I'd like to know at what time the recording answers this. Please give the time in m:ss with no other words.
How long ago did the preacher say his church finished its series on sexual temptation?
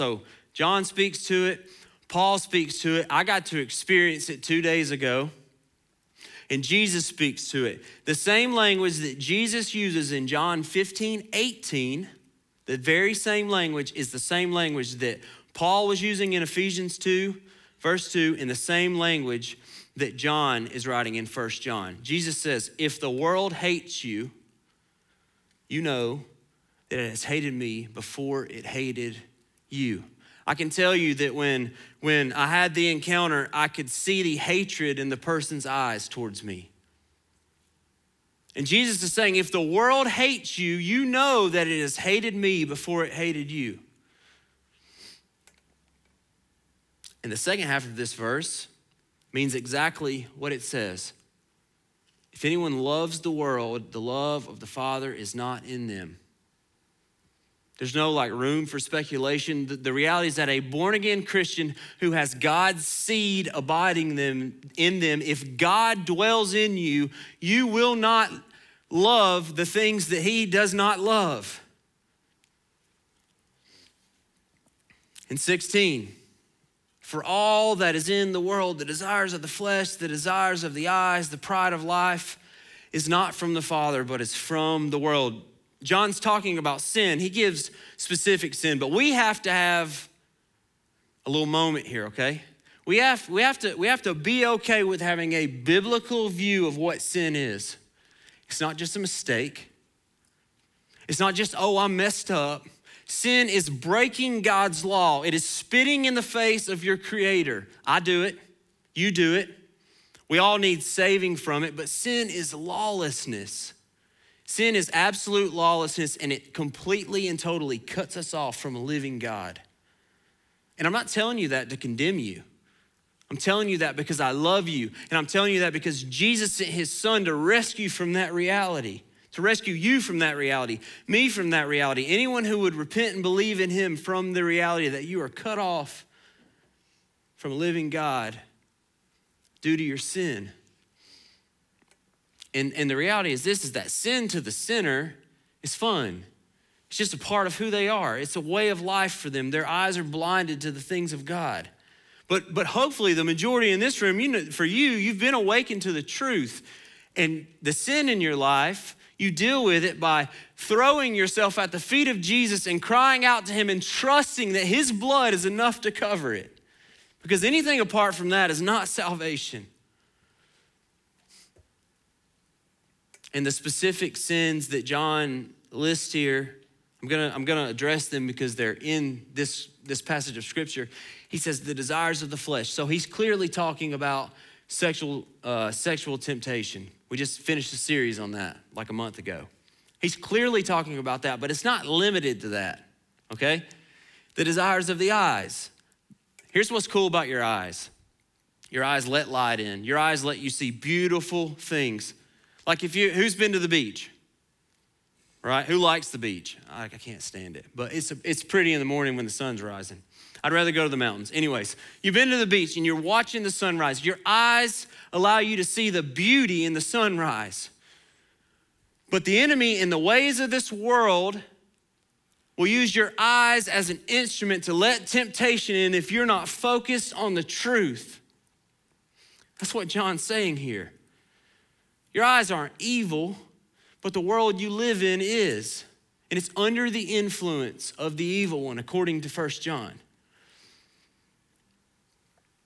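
3:08.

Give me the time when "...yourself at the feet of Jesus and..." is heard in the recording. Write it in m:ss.
2:41.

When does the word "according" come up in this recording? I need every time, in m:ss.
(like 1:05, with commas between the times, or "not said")
3:58.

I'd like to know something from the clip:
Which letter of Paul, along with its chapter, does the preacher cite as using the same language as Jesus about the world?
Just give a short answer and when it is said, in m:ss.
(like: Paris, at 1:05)
Ephesians 2, at 0:16.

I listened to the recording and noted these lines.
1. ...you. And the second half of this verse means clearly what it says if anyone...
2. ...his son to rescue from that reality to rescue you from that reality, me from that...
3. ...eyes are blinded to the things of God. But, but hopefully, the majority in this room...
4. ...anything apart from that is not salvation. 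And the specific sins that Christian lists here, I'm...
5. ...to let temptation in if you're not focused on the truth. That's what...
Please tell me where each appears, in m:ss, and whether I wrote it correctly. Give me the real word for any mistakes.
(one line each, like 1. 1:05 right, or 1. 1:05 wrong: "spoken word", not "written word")
1. 0:43 wrong: "exactly", not "clearly"
2. 2:06 right
3. 2:29 right
4. 2:47 wrong: "John", not "Christian"
5. 3:44 right.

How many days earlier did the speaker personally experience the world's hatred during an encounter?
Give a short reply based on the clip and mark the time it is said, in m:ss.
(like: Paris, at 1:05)
2, at 0:04.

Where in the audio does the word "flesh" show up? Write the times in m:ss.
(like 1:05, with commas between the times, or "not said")
1:19, 3:02.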